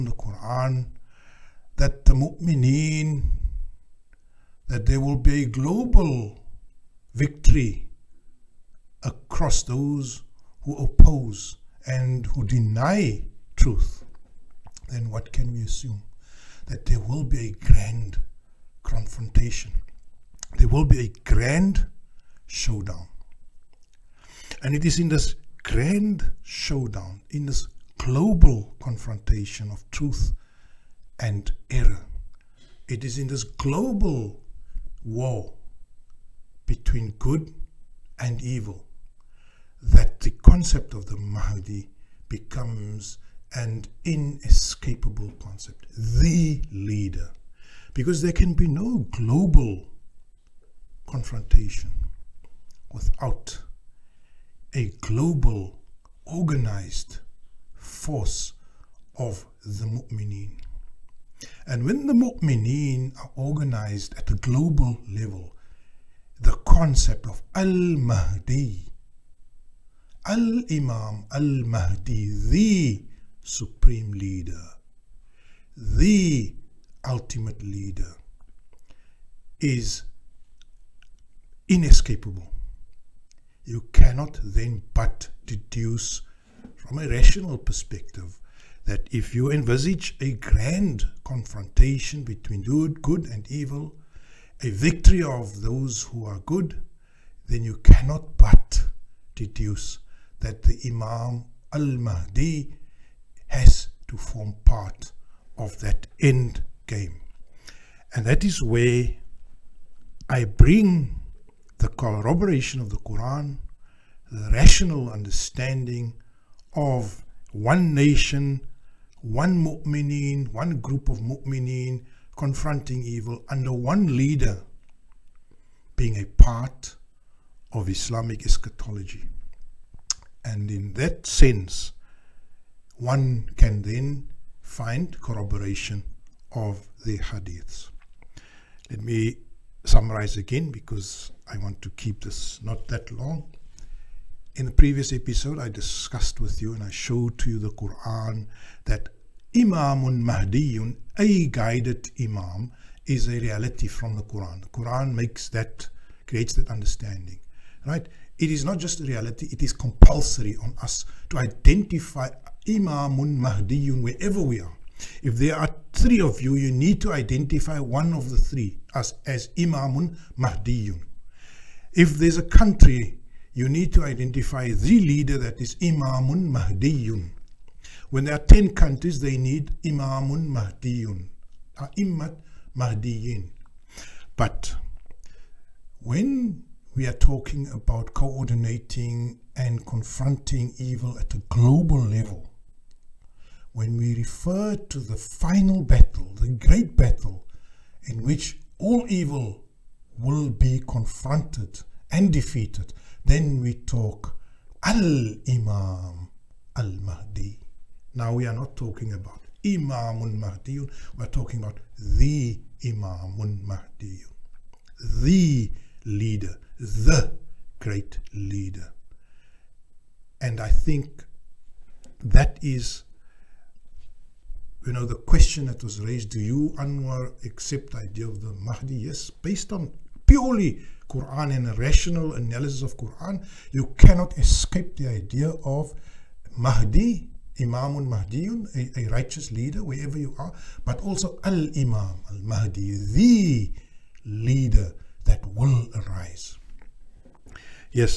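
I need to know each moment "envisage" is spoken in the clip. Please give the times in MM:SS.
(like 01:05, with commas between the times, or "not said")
01:29.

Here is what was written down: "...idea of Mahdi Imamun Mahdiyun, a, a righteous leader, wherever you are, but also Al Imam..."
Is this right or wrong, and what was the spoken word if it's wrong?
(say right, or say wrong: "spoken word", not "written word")
right.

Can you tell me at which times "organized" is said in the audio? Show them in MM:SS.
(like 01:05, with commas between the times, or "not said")
00:56, 01:03.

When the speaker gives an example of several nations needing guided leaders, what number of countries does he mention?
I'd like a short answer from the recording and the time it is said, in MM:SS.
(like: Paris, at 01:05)
10, at 02:58.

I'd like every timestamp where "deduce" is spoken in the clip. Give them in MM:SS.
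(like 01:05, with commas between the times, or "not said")
01:25, 01:39.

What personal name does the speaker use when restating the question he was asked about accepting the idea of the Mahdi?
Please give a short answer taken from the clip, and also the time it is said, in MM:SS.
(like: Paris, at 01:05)
Anwar, at 03:46.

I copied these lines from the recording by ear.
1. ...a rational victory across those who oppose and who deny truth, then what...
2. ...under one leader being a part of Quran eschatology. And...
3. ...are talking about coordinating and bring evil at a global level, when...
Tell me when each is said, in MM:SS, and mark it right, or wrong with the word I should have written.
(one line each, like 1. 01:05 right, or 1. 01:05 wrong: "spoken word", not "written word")
1. 00:05 wrong: "global", not "rational"
2. 02:03 wrong: "Islamic", not "Quran"
3. 03:07 wrong: "confronting", not "bring".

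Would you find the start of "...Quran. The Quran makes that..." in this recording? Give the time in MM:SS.
02:34.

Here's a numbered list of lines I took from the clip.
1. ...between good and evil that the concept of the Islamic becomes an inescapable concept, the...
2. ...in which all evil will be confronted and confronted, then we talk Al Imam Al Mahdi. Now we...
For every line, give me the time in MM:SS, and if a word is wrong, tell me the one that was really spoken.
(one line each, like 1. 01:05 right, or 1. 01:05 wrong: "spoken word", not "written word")
1. 00:36 wrong: "Mahdi", not "Islamic"
2. 03:18 wrong: "defeated", not "confronted".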